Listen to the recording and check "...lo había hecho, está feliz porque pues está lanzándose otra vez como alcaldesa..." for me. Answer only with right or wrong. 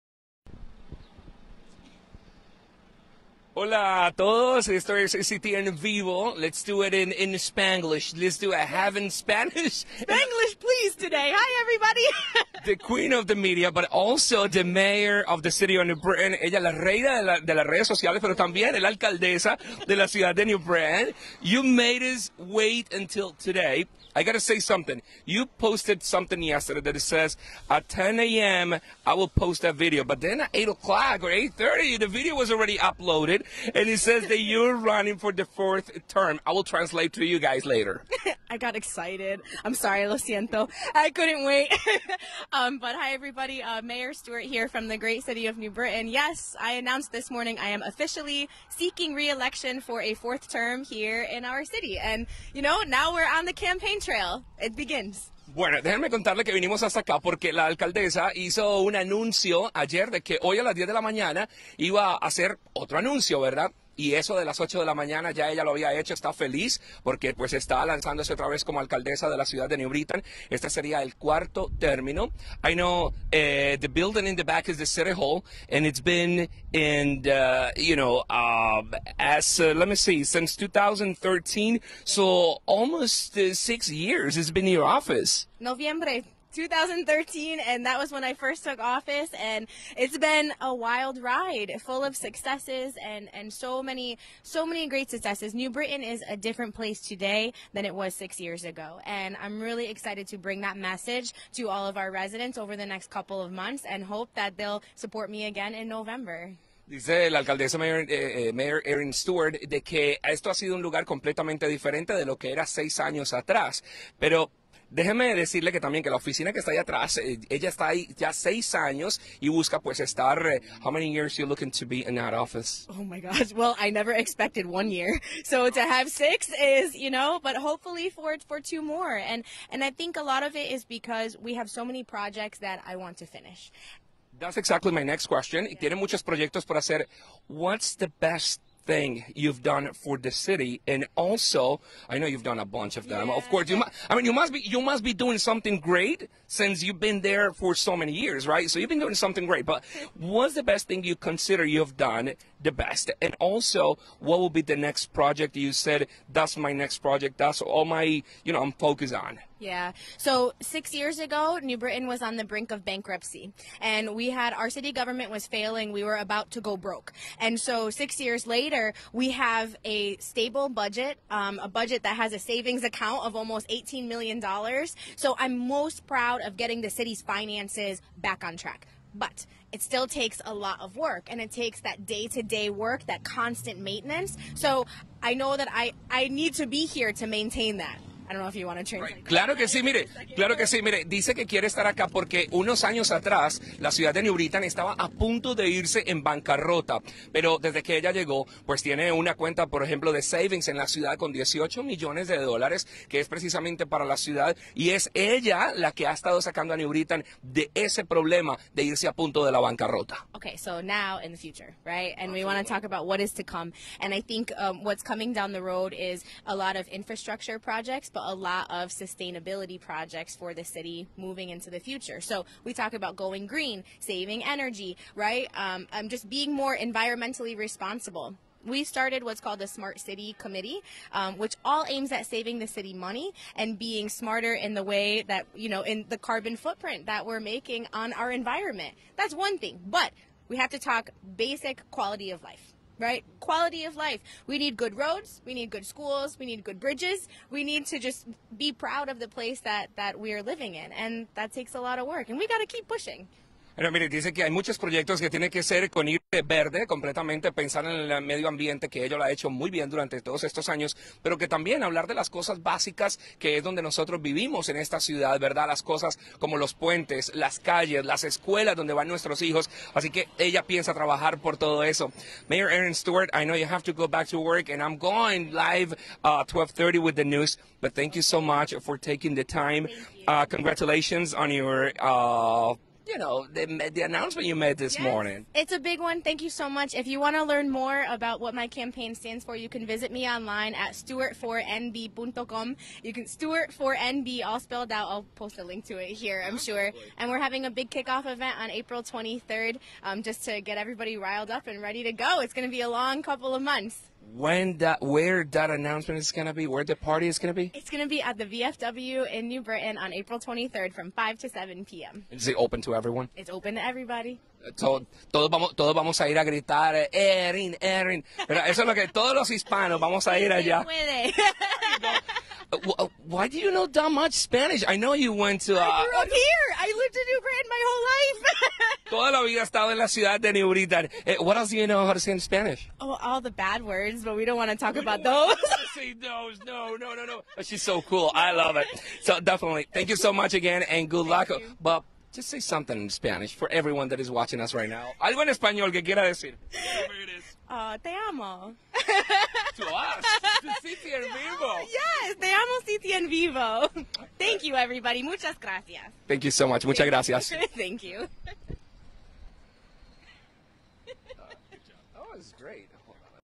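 right.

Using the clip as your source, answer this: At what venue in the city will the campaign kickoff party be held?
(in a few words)
the VFW.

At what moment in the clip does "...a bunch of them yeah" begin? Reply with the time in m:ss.
2:22.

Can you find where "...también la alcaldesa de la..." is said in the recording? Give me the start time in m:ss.
0:18.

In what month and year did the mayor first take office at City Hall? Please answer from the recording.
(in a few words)
November 2013.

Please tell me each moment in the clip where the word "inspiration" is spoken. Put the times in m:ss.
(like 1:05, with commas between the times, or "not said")
not said.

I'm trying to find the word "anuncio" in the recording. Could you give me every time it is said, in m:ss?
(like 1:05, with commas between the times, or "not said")
0:58, 1:02.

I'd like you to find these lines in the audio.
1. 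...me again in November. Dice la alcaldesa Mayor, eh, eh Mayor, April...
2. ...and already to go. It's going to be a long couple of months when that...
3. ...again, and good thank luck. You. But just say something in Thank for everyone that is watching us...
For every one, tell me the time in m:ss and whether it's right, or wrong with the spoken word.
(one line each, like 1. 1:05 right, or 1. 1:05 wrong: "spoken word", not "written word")
1. 1:45 wrong: "Erin", not "April"
2. 5:01 wrong: "ready", not "already"
3. 5:40 wrong: "Spanish", not "Thank".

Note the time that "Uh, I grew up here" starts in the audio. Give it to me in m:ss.
5:25.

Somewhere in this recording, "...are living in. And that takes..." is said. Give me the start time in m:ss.
4:10.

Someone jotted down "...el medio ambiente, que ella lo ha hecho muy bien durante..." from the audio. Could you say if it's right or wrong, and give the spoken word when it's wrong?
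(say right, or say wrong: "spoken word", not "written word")
right.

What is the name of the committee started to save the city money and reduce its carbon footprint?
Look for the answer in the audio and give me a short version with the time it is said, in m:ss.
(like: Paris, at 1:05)
Smart City Committee, at 3:49.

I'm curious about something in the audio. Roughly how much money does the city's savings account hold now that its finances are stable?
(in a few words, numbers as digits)
$18 million.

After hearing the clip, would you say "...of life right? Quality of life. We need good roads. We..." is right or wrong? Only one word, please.
right.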